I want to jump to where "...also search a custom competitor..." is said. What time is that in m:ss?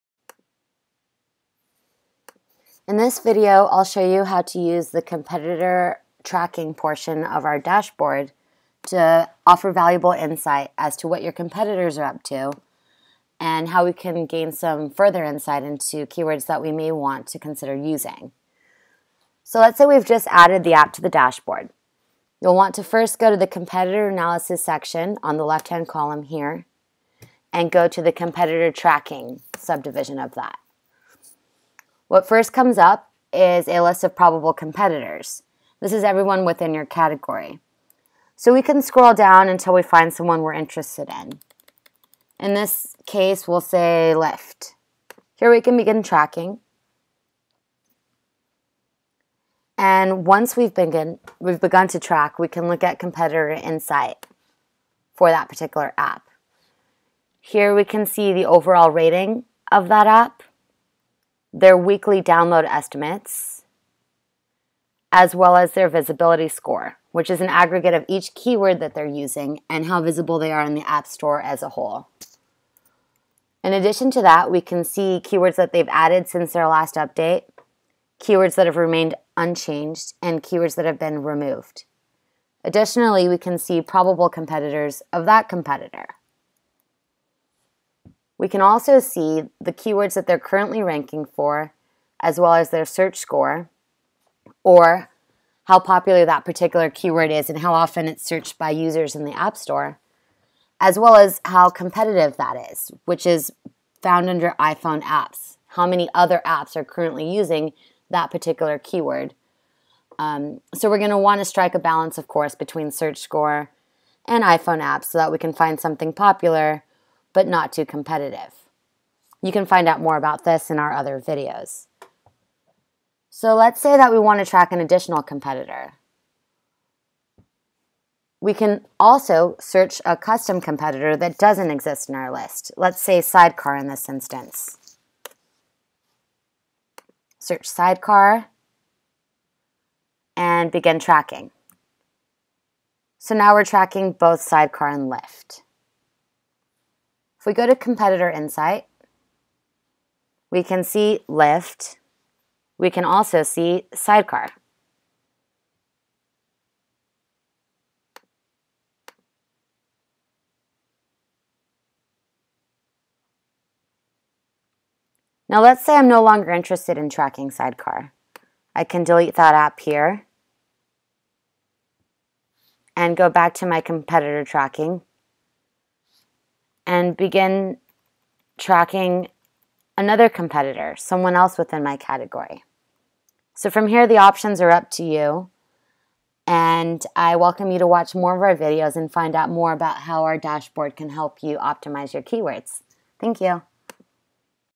2:08.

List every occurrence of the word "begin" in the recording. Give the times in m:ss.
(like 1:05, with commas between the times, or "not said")
0:45, 2:20, 2:57.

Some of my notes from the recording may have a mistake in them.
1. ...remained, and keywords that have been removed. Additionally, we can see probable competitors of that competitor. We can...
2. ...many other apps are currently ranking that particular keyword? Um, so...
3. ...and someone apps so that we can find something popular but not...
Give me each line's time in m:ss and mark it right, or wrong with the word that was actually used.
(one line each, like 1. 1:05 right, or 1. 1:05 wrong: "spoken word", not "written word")
1. 1:19 wrong: "unchanged", not "remained"
2. 1:45 wrong: "using", not "ranking"
3. 1:54 wrong: "iPhone", not "someone".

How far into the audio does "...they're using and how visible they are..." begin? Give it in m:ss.
1:08.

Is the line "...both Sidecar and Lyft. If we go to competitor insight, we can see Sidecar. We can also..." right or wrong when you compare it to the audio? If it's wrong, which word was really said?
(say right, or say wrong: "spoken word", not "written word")
wrong: "Lyft", not "Sidecar".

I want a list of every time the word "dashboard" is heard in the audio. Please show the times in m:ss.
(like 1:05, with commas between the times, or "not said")
0:07, 0:21, 3:10.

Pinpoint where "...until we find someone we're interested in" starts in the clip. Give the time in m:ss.
0:39.